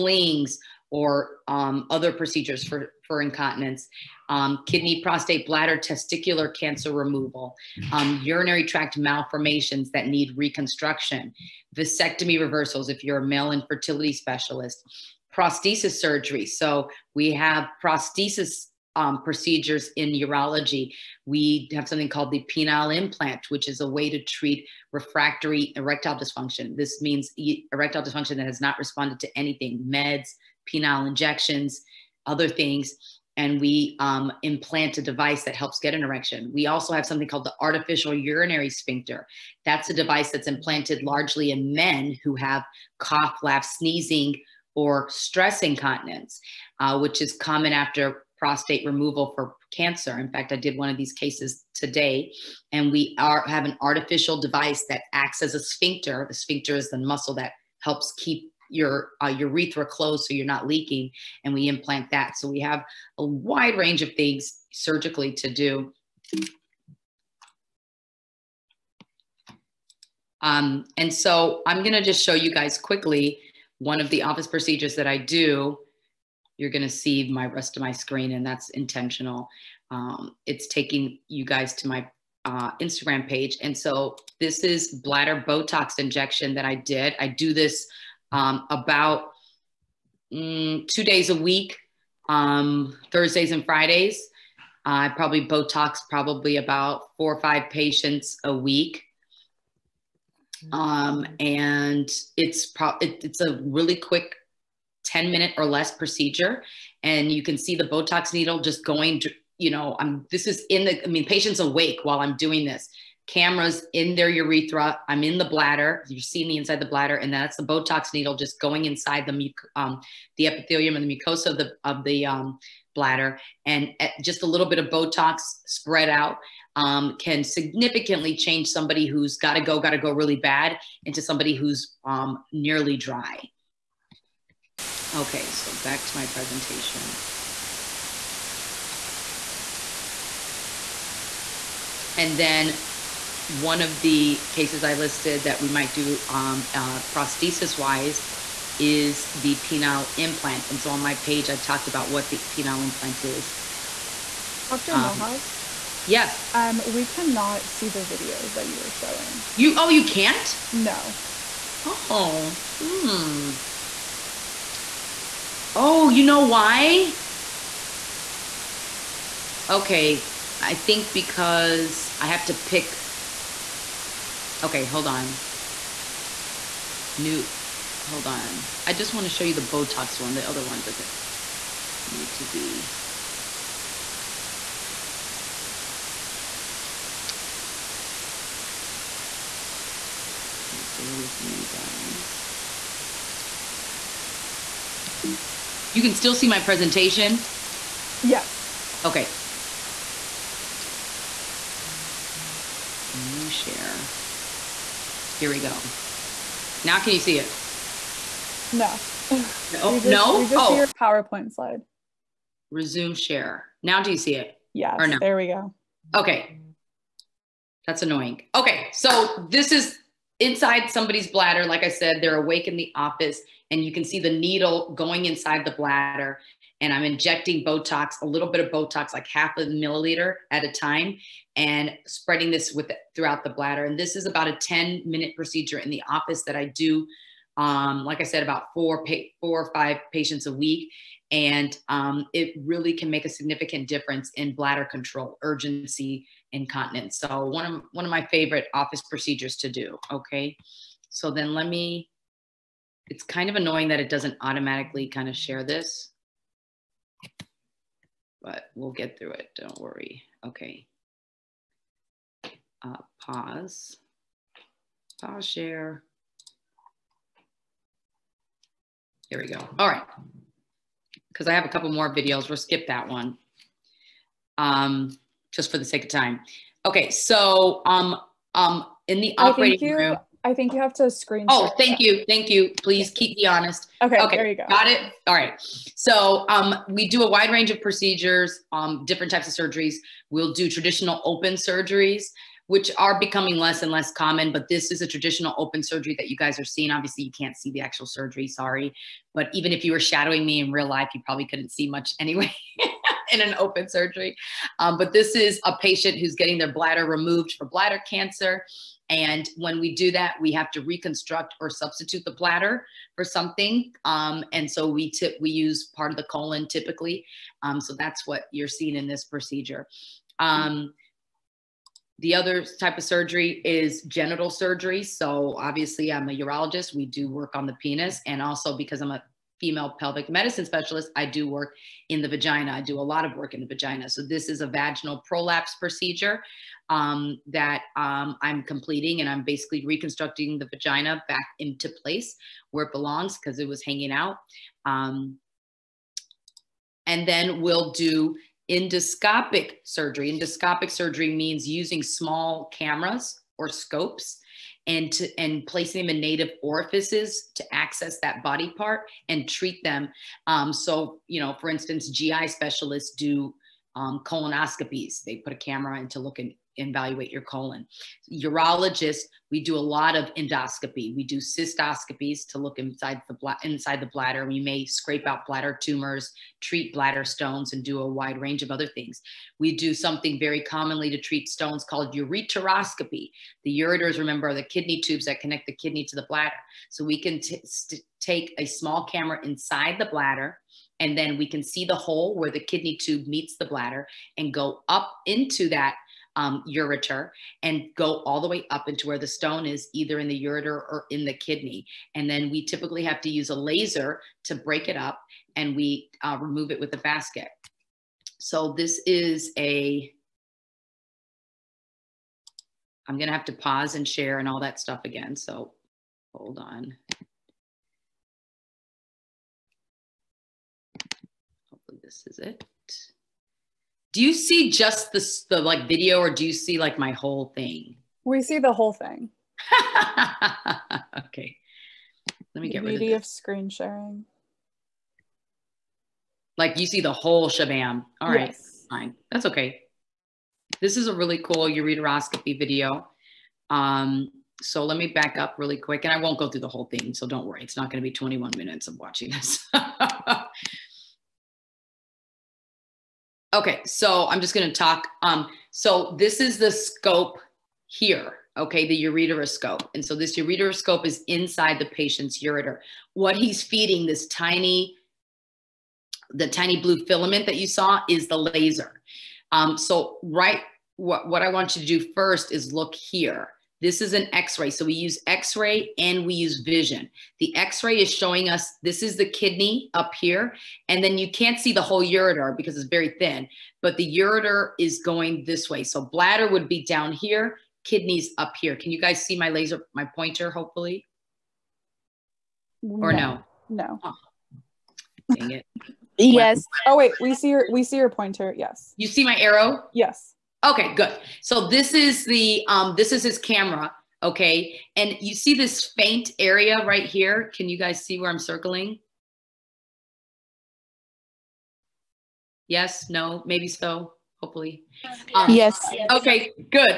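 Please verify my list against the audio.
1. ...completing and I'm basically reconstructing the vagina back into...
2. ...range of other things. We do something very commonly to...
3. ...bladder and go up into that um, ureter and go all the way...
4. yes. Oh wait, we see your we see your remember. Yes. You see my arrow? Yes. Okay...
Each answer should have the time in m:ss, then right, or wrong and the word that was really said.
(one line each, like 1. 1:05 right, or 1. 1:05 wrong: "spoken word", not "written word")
1. 5:38 right
2. 6:18 right
3. 6:33 right
4. 8:16 wrong: "pointer", not "remember".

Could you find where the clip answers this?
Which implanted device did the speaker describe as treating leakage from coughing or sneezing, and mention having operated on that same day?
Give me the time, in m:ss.
0:37.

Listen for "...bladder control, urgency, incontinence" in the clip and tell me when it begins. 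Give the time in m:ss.
4:04.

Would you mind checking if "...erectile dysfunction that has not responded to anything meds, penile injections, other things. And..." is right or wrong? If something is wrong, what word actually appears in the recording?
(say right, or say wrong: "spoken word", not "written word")
right.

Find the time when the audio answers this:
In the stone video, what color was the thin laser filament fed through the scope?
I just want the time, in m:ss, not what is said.
7:46.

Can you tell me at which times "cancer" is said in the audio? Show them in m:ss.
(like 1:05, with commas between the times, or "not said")
0:06, 0:49, 5:08.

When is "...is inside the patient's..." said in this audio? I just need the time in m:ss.
7:41.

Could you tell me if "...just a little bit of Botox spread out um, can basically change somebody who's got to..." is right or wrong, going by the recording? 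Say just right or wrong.
wrong.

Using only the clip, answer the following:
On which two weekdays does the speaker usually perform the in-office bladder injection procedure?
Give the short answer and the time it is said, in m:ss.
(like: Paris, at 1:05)
Thursdays and Fridays, at 1:33.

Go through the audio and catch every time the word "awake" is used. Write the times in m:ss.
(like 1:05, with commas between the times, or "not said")
1:51, 3:42.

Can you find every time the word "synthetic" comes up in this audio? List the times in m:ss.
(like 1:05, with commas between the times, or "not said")
not said.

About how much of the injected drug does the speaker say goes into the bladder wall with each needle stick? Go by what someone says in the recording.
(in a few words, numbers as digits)
half a milliliter.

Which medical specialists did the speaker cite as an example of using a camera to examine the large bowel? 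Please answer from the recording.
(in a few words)
GI specialists.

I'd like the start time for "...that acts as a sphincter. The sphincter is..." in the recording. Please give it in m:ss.
0:54.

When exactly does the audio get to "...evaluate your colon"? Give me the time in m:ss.
6:06.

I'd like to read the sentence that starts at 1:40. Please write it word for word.
um, and it's pro- it, it's a really quick 10 minute or less procedure.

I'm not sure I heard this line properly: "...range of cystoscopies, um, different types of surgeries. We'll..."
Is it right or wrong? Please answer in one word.
wrong.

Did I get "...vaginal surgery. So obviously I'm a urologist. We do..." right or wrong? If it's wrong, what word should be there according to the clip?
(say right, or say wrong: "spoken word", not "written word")
wrong: "genital", not "vaginal".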